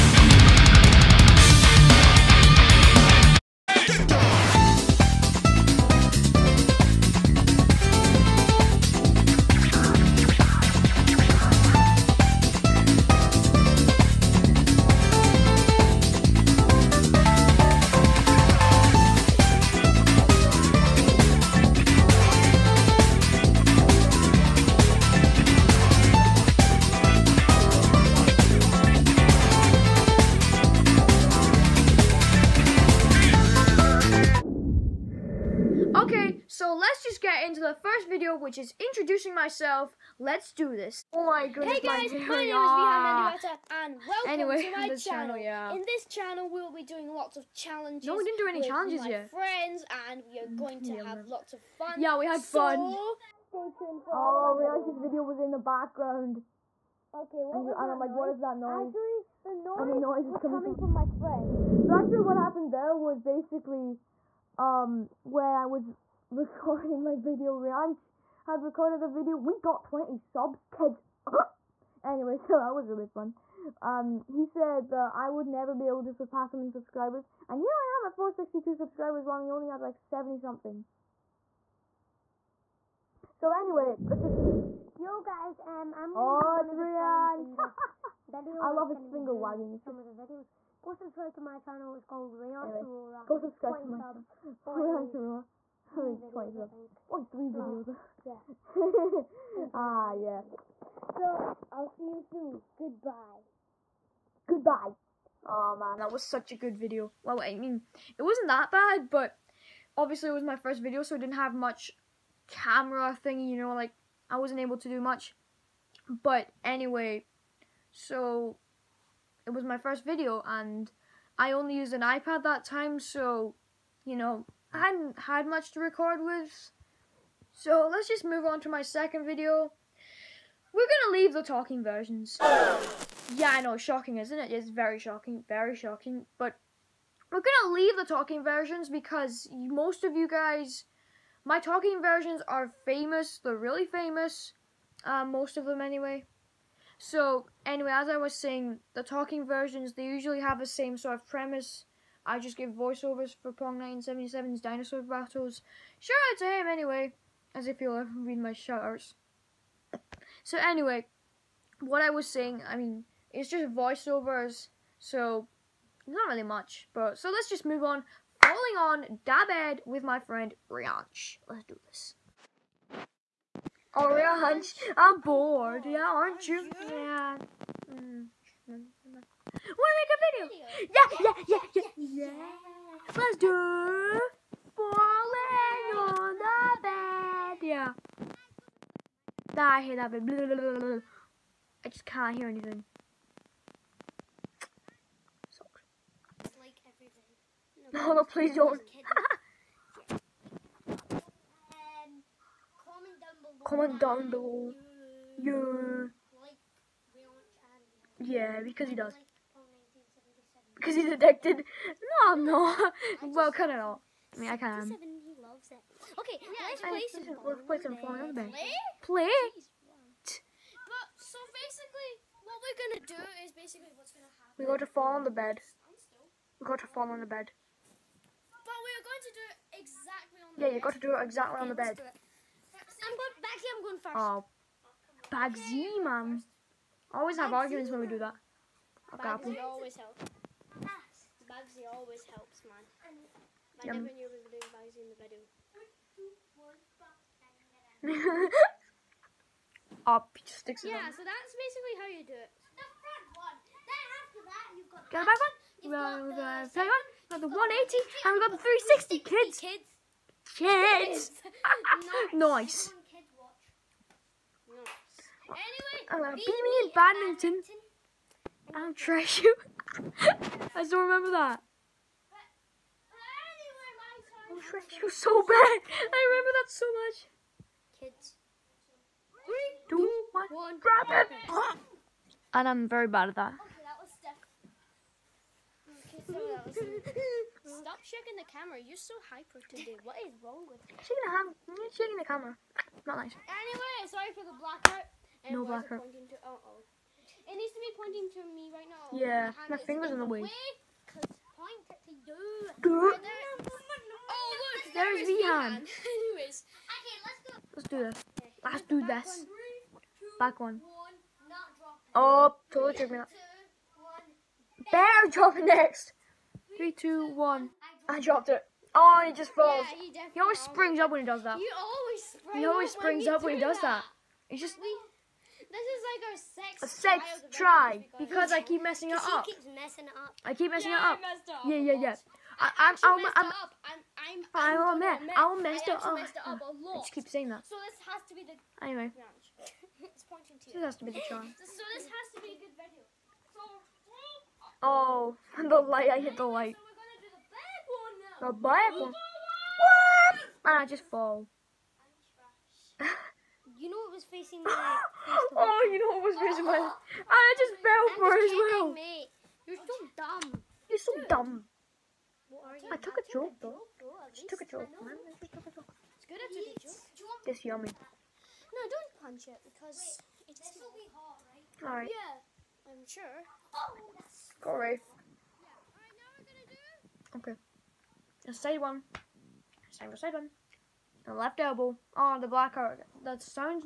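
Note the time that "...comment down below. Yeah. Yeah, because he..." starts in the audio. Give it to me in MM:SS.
03:23.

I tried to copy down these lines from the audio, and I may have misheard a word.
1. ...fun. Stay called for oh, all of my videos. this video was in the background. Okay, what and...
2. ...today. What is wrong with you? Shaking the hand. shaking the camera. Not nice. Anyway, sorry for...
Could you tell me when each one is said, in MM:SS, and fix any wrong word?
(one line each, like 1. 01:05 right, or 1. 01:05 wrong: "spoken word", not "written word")
1. 00:52 wrong: "tuned", not "called"
2. 04:49 right.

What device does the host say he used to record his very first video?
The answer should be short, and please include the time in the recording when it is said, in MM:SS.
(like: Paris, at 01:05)
iPad, at 02:01.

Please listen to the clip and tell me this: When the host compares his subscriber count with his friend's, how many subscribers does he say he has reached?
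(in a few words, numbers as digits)
462.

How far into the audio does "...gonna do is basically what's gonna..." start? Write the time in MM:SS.
03:42.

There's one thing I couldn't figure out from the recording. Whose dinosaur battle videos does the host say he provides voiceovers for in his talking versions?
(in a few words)
Pong 1977.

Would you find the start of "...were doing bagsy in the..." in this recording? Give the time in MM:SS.
04:04.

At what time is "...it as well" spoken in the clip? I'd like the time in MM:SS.
05:58.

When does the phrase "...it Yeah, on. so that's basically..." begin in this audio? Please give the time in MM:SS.
04:10.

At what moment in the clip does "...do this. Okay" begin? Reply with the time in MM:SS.
05:07.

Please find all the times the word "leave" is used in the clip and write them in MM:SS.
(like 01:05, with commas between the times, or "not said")
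02:11, 02:17.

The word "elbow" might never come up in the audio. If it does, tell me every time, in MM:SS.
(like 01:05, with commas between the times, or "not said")
06:21.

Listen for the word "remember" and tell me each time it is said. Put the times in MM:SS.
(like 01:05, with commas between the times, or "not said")
04:30, 04:36.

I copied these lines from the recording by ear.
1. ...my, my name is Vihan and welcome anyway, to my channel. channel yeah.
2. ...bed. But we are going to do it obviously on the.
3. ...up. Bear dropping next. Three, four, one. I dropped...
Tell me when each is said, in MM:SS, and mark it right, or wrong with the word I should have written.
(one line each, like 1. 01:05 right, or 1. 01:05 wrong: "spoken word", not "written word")
1. 00:42 right
2. 03:47 wrong: "exactly", not "obviously"
3. 05:13 wrong: "two", not "four".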